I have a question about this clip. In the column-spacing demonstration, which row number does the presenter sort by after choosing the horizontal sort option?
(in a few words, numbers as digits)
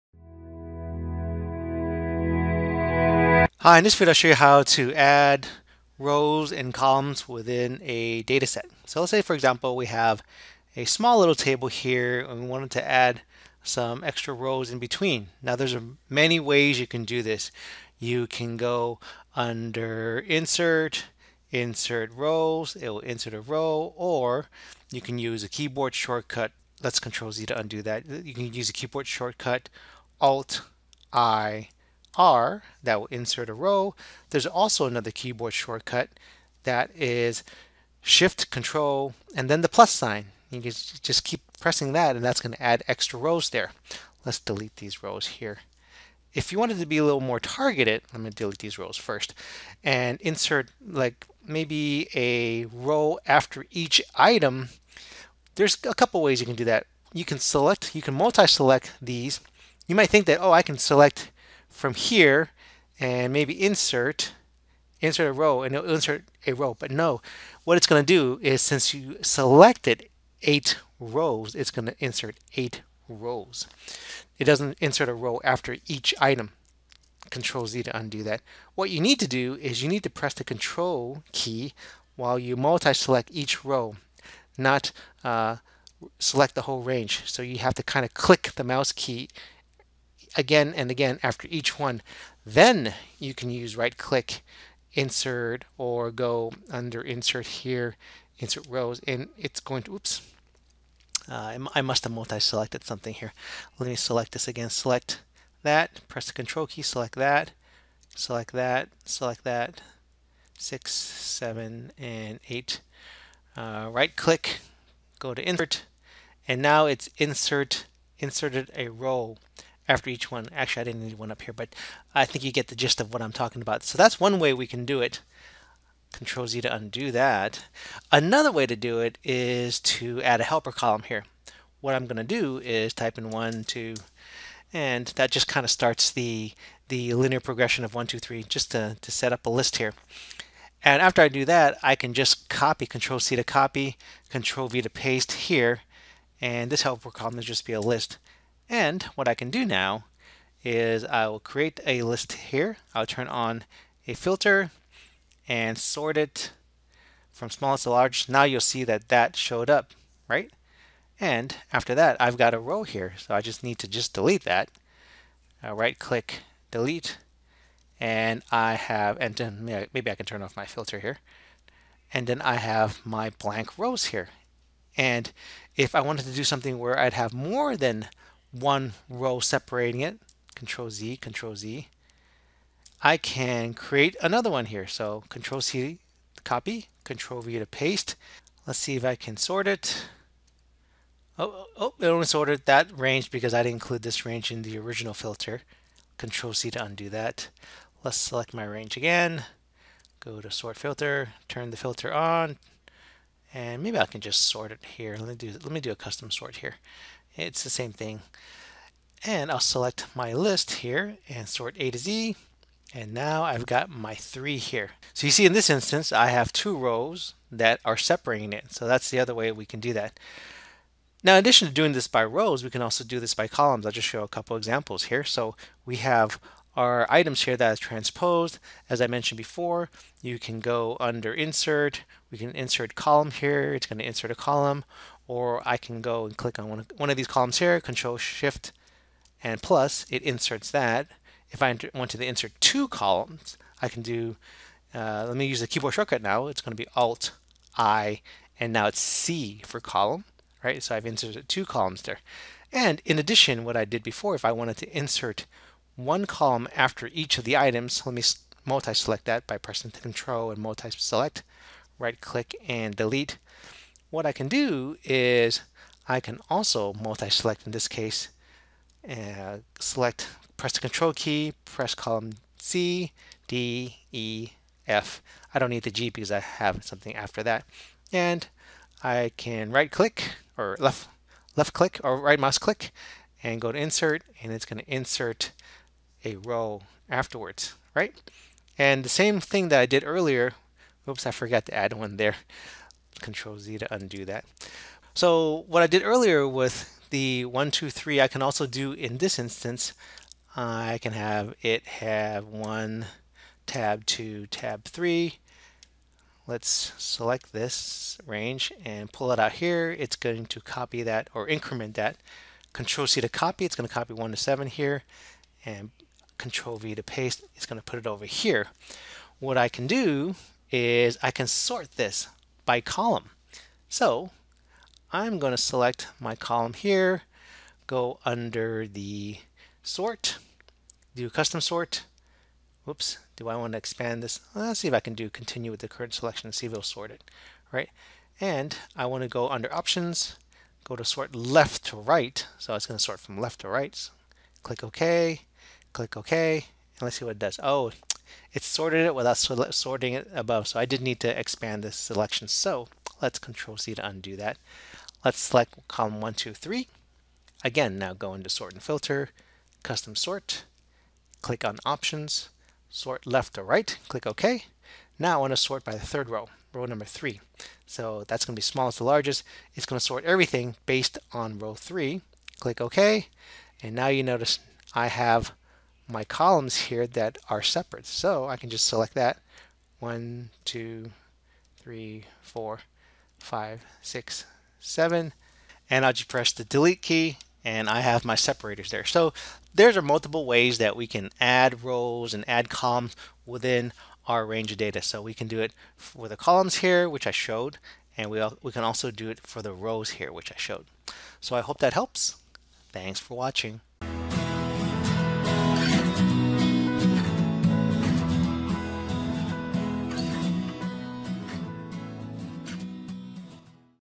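3.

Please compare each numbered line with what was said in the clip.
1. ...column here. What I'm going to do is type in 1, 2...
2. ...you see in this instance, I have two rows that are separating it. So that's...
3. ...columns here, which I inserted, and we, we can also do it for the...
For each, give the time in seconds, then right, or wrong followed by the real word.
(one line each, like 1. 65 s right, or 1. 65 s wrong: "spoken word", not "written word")
1. 130 s right
2. 215 s right
3. 396 s wrong: "showed", not "inserted".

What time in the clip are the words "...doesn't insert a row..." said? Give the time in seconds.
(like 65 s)
74 s.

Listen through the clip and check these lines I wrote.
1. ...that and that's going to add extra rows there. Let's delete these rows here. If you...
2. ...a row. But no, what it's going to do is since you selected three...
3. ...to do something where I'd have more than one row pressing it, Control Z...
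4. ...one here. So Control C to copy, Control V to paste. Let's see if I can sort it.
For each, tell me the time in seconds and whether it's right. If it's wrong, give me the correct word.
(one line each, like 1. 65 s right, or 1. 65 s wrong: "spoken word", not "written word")
1. 41 s right
2. 66 s wrong: "eight", not "three"
3. 176 s wrong: "separating", not "pressing"
4. 184 s right.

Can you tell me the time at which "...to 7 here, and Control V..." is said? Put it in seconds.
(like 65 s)
314 s.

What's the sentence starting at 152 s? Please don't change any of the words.
I'll turn on a filter and sort it from smallest to large.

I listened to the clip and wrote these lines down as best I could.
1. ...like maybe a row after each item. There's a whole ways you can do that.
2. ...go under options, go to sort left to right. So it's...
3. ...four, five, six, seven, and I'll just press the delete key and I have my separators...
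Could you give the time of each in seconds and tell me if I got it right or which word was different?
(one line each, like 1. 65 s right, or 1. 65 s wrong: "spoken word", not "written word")
1. 50 s wrong: "couple", not "whole"
2. 339 s right
3. 382 s right.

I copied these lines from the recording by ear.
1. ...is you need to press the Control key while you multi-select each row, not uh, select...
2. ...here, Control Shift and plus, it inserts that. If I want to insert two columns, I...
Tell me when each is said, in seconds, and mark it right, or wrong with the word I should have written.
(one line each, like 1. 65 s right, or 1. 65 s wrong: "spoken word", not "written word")
1. 79 s right
2. 237 s right.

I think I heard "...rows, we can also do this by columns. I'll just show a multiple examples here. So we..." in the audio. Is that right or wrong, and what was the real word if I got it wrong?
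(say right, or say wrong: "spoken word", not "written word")
wrong: "couple", not "multiple".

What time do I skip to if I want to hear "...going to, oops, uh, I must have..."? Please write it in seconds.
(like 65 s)
99 s.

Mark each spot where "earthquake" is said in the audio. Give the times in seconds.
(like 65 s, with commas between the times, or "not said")
not said.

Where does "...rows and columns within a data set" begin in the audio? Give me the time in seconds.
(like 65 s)
5 s.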